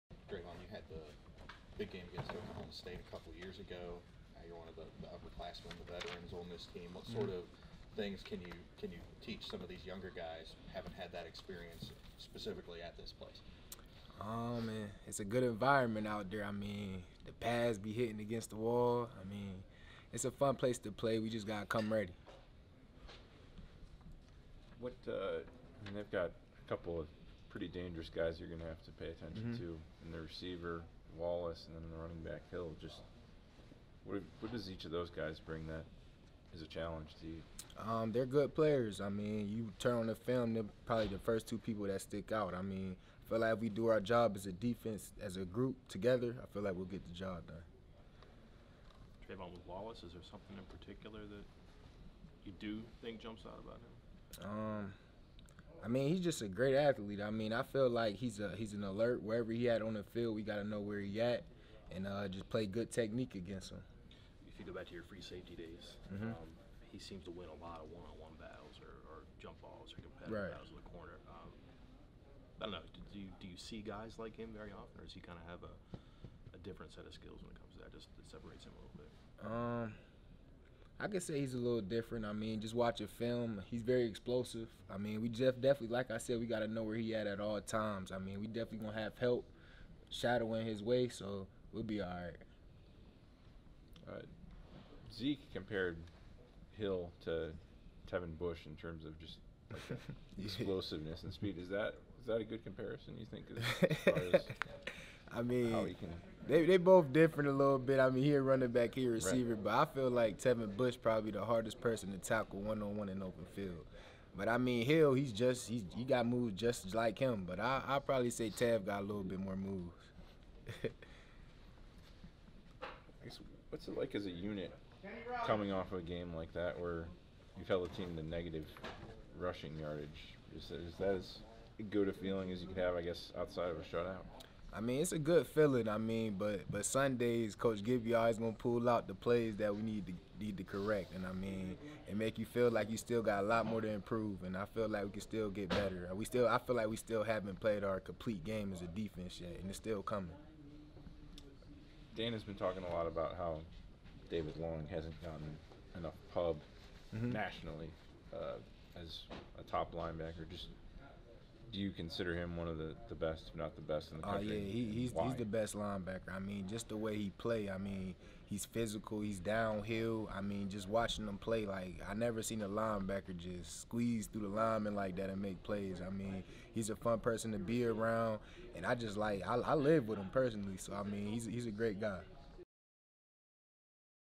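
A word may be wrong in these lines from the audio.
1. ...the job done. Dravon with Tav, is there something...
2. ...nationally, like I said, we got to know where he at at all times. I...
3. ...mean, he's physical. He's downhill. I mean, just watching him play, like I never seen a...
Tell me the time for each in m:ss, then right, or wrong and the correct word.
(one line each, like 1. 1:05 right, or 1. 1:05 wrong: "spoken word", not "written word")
1. 0:47 wrong: "Wallace", not "Tav"
2. 1:25 wrong: "definitely", not "nationally"
3. 2:47 right.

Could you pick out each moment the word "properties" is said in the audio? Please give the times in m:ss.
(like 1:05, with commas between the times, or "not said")
not said.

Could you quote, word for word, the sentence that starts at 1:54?
But I mean, Hill, he's just he's, he got moves just like him.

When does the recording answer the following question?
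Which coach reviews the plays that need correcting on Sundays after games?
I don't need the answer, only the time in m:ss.
2:17.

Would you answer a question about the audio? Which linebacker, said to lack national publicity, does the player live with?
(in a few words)
David Long.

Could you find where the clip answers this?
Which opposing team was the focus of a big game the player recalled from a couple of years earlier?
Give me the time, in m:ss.
0:02.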